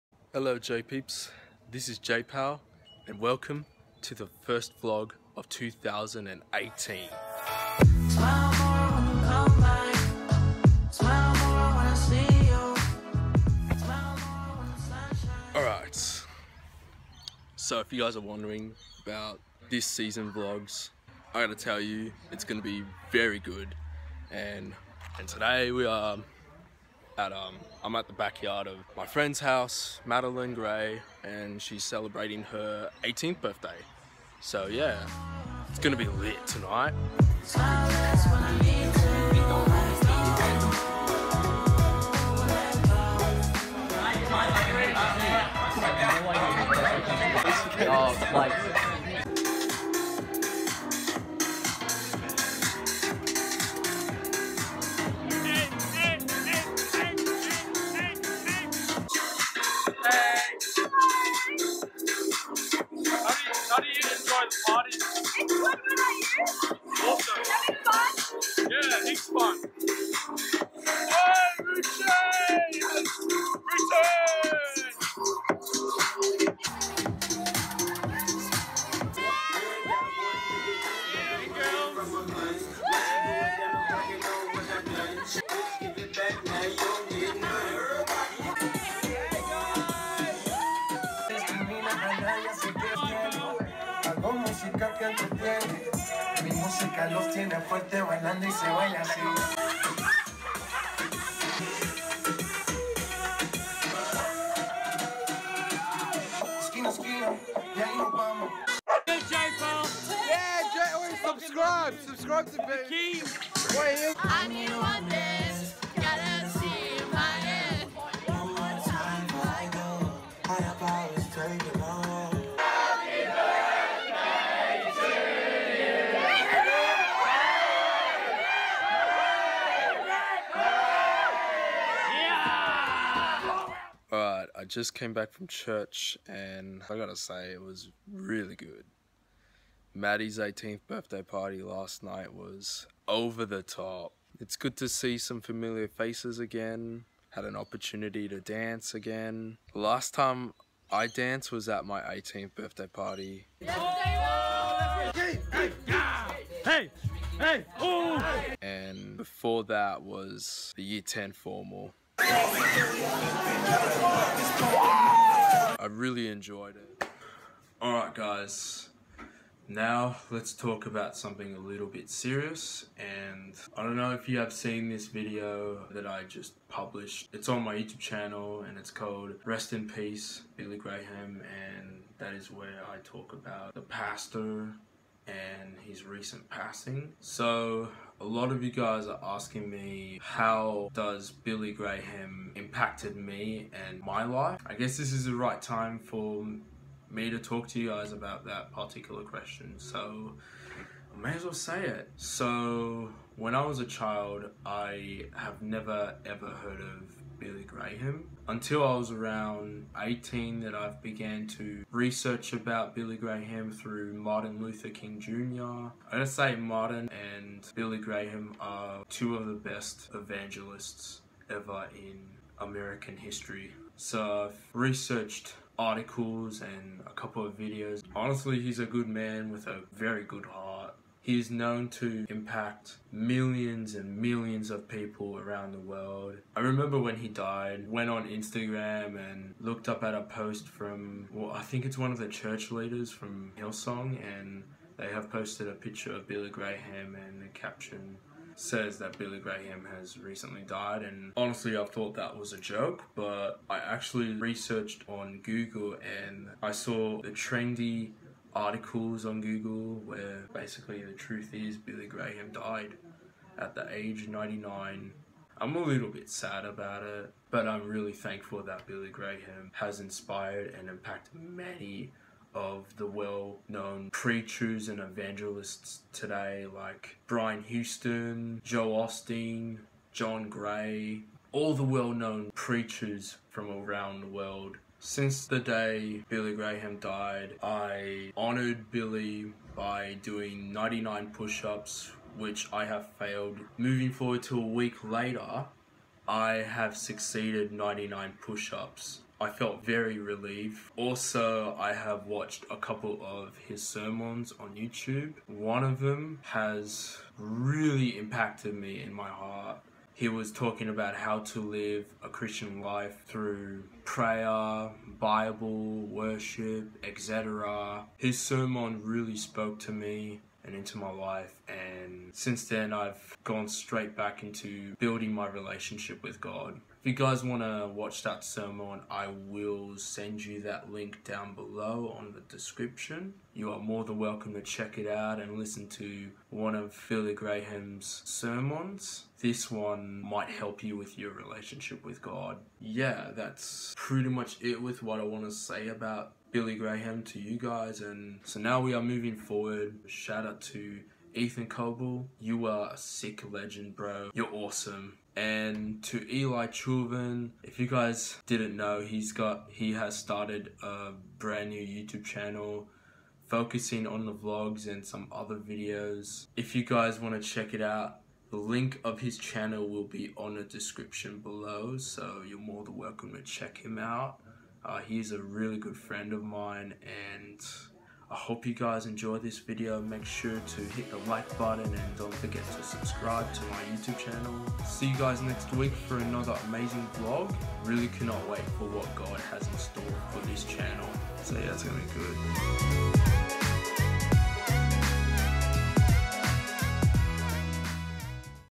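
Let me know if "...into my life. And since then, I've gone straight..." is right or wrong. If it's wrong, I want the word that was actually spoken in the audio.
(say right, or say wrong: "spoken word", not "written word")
right.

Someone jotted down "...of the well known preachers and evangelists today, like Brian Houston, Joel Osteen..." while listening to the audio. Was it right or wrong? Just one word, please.
right.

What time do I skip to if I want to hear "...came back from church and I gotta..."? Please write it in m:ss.
2:14.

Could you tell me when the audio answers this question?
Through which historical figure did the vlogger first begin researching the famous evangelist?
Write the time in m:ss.
3:34.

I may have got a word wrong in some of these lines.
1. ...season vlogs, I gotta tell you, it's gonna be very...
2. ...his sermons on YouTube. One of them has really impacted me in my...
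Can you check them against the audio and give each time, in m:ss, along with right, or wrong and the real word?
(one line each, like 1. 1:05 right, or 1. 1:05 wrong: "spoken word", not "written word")
1. 0:19 right
2. 5:03 right.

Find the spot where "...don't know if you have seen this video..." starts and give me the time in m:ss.
2:53.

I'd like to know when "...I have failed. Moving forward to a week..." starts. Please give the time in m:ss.
4:52.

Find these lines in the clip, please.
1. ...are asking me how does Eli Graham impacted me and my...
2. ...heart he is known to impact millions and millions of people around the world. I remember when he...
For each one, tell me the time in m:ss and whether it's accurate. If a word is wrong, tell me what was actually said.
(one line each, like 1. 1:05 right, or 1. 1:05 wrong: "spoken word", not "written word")
1. 3:09 wrong: "Billy", not "Eli"
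2. 3:50 right.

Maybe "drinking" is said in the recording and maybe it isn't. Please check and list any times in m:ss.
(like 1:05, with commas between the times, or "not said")
not said.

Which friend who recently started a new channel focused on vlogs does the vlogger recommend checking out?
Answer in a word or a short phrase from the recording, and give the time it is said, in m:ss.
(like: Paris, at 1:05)
Eli Chauvin, at 5:56.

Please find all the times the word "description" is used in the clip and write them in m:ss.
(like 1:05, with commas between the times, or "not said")
5:32, 6:10.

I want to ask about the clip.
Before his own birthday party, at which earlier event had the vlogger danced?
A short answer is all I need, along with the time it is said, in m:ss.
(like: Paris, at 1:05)
year 10 formal, at 2:40.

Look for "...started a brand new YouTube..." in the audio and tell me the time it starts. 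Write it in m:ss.
6:00.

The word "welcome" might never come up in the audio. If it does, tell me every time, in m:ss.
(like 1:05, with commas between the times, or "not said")
0:03, 5:34, 6:12.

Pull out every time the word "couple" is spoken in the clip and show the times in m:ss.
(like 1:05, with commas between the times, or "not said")
3:47, 5:02.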